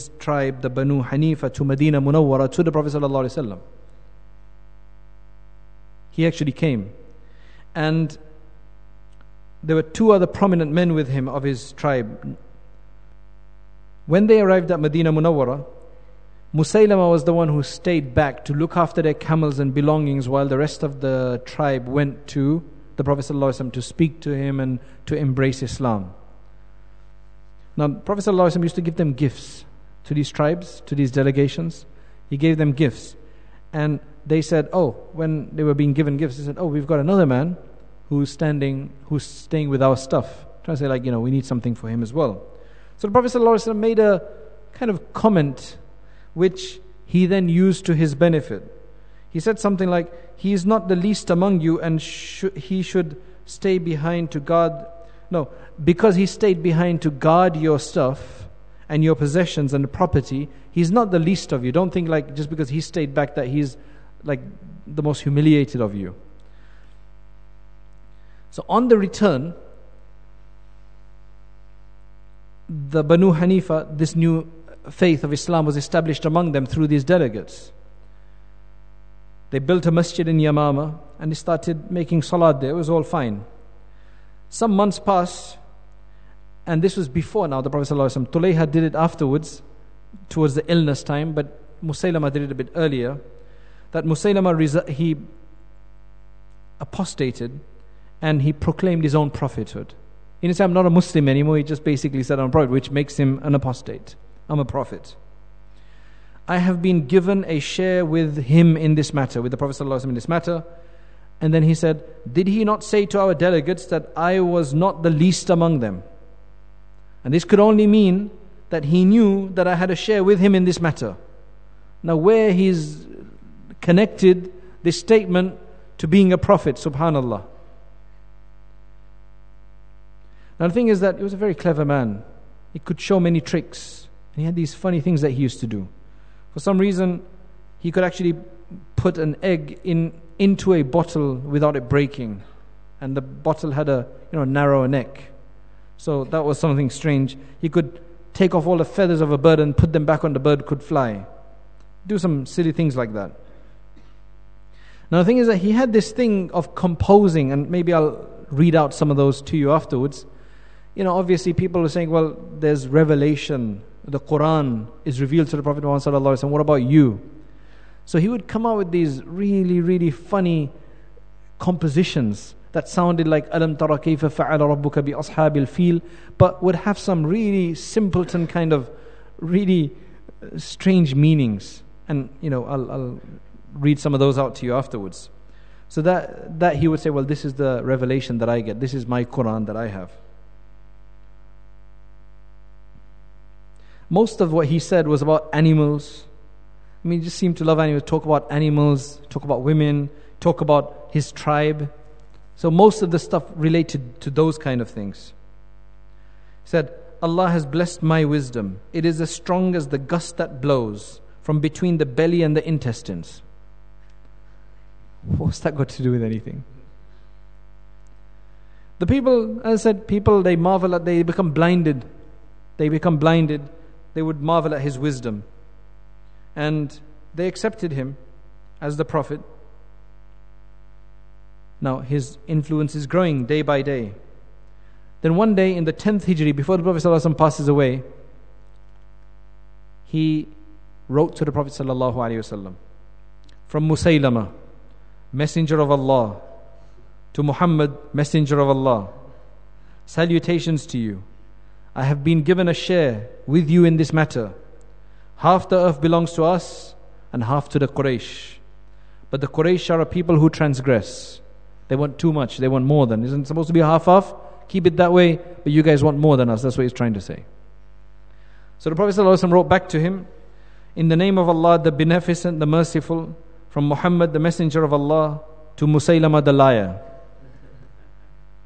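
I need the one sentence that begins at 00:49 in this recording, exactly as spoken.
He said something like, He is not the least among you, and sh- he should stay behind to guard.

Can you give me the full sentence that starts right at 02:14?
And he had these funny things that he used to do.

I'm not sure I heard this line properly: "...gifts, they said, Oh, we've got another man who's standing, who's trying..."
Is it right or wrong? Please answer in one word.
wrong.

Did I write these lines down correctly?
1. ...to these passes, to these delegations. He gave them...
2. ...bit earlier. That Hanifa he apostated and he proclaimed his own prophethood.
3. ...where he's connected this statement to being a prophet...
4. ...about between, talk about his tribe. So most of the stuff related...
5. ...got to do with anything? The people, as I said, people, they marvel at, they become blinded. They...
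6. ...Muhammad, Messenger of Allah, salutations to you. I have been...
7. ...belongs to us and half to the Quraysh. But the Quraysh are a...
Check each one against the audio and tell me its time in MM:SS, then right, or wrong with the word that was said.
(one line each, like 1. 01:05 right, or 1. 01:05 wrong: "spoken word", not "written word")
1. 00:30 wrong: "tribes", not "passes"
2. 01:32 wrong: "Musaylama", not "Hanifa"
3. 02:02 right
4. 03:19 wrong: "women", not "between"
5. 03:35 right
6. 04:07 right
7. 04:16 right.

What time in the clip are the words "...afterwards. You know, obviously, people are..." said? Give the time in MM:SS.
02:39.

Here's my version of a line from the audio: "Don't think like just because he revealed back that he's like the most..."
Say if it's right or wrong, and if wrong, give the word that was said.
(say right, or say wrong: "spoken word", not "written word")
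wrong: "stayed", not "revealed".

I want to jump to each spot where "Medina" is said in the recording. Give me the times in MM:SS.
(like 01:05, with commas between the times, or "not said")
00:01, 00:14.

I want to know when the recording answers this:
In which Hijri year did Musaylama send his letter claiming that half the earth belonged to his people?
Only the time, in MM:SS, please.
03:55.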